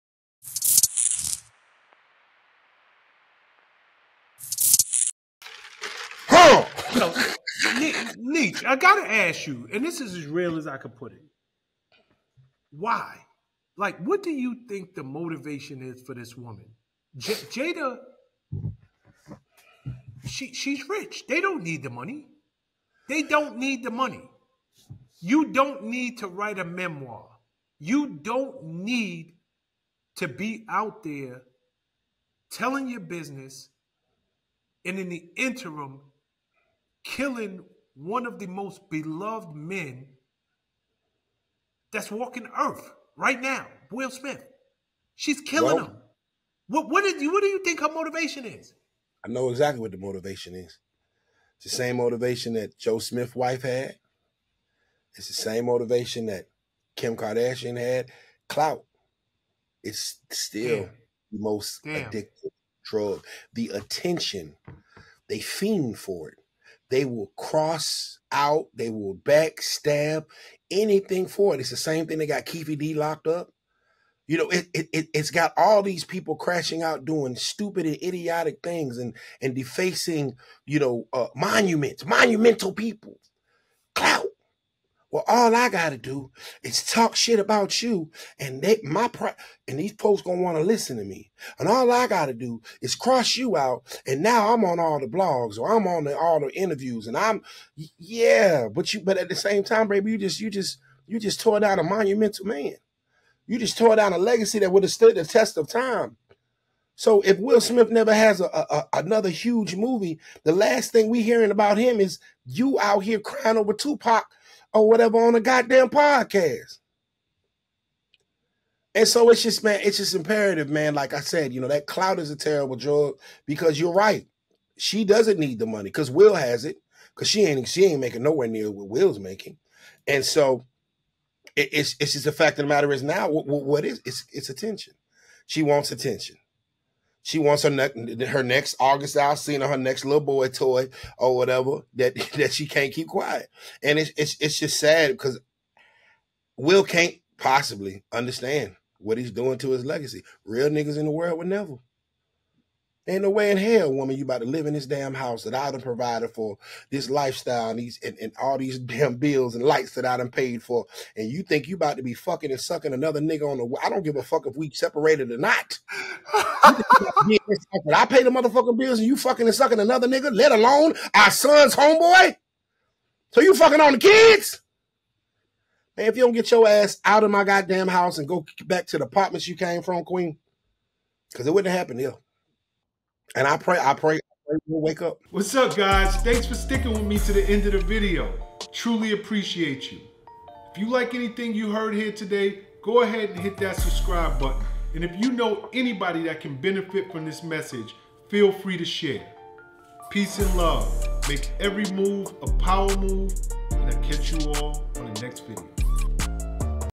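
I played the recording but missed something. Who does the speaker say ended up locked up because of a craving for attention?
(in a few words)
Keefe D.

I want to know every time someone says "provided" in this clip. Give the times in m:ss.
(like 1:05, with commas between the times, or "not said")
2:35.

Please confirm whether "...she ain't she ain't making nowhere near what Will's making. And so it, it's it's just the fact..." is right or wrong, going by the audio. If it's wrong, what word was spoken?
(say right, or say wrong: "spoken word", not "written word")
right.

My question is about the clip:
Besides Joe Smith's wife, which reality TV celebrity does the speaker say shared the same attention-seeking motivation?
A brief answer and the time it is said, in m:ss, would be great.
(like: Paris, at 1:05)
Kim Kardashian, at 0:56.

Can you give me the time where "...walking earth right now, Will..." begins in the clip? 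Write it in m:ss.
0:42.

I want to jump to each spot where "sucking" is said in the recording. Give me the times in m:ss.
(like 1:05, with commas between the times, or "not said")
2:42, 2:49.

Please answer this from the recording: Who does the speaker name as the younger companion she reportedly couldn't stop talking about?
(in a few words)
August Alsina.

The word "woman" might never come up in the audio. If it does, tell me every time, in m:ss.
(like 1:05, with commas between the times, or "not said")
0:16, 2:33.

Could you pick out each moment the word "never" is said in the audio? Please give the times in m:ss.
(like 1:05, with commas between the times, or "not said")
1:47, 2:31.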